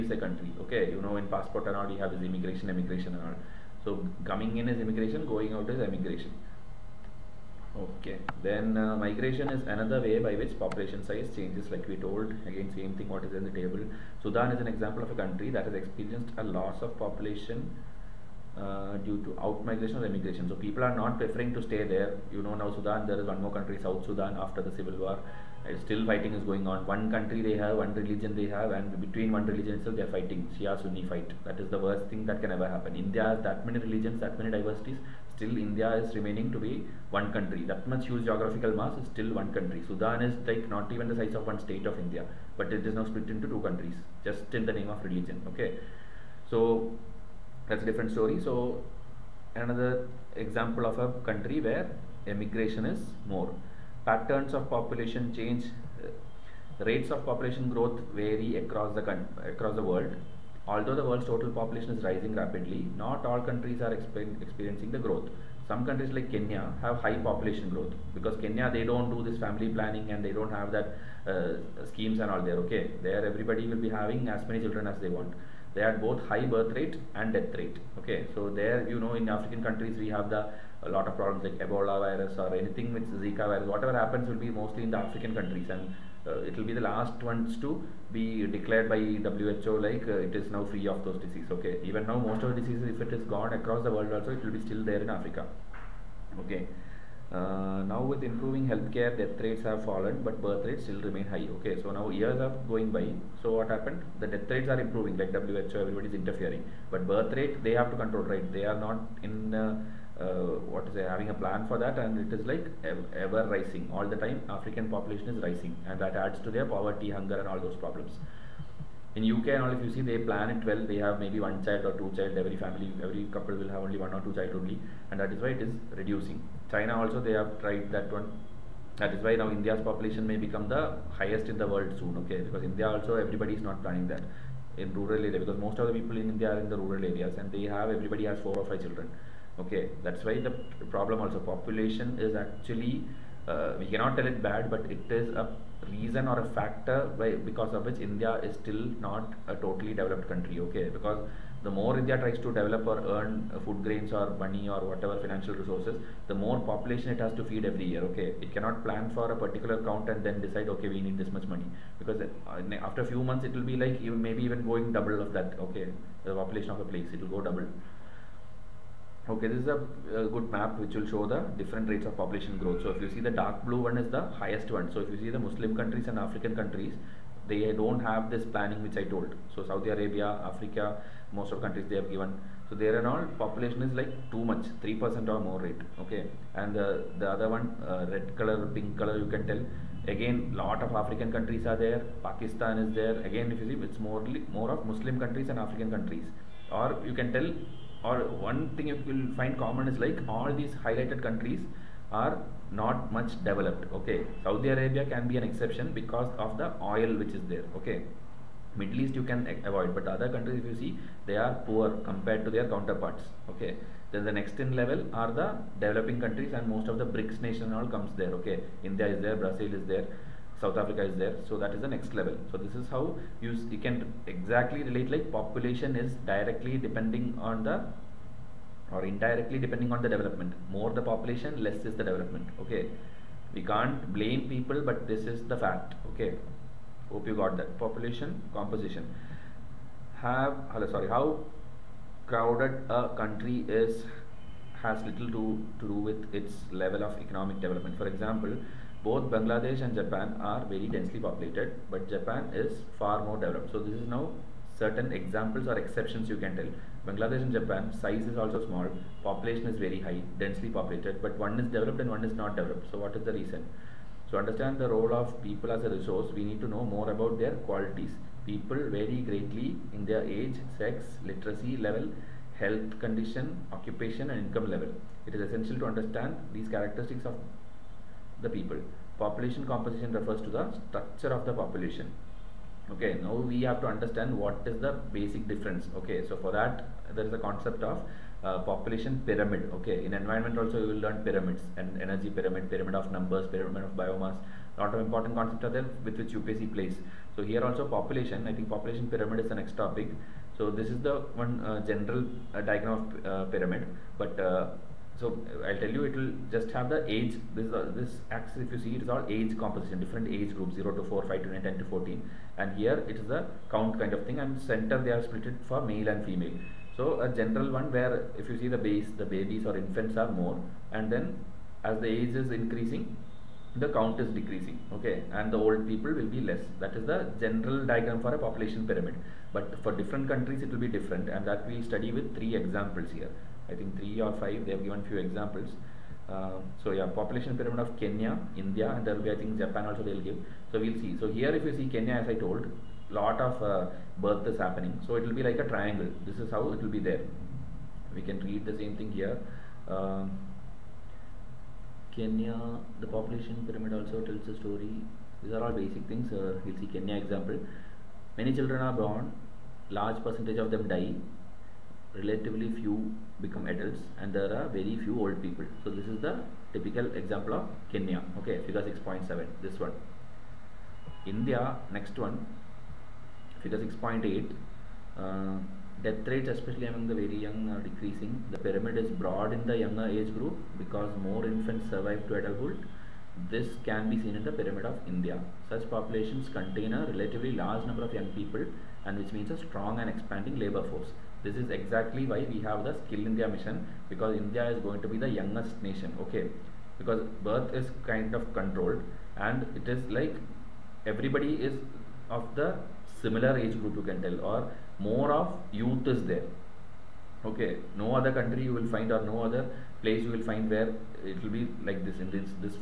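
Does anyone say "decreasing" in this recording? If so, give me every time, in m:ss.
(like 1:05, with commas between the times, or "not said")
5:24, 6:17.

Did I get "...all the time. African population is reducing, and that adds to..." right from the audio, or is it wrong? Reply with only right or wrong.
wrong.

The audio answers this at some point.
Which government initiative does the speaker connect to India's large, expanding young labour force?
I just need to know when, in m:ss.
6:33.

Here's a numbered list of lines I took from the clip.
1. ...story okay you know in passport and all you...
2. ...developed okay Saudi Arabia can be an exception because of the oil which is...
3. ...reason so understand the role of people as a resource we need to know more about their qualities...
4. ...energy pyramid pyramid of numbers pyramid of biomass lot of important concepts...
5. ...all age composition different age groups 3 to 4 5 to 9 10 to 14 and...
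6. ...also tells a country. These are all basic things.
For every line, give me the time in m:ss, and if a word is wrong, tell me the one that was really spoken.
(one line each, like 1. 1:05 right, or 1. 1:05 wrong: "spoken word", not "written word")
1. 0:00 wrong: "country", not "story"
2. 3:23 right
3. 4:23 right
4. 4:52 right
5. 5:09 wrong: "0", not "3"
6. 5:53 wrong: "story", not "country".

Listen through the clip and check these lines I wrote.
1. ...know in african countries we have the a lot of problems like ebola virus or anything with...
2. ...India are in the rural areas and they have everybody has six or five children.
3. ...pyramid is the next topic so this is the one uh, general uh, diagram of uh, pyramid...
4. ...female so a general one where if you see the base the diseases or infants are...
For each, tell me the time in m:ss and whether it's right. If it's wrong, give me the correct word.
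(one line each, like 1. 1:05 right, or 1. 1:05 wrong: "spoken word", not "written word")
1. 1:19 right
2. 2:16 wrong: "four", not "six"
3. 4:59 right
4. 5:16 wrong: "babies", not "diseases".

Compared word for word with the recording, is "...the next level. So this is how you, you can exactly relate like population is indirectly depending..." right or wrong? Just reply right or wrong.
wrong.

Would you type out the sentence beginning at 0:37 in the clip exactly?
That much huge geographical mass is still one country.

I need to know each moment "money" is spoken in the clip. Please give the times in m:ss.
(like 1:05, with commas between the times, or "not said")
2:34, 2:41.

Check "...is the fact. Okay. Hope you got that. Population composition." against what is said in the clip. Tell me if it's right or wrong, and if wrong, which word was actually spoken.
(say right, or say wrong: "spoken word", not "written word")
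right.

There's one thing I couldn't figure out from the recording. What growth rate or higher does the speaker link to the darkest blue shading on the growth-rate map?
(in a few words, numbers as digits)
3%.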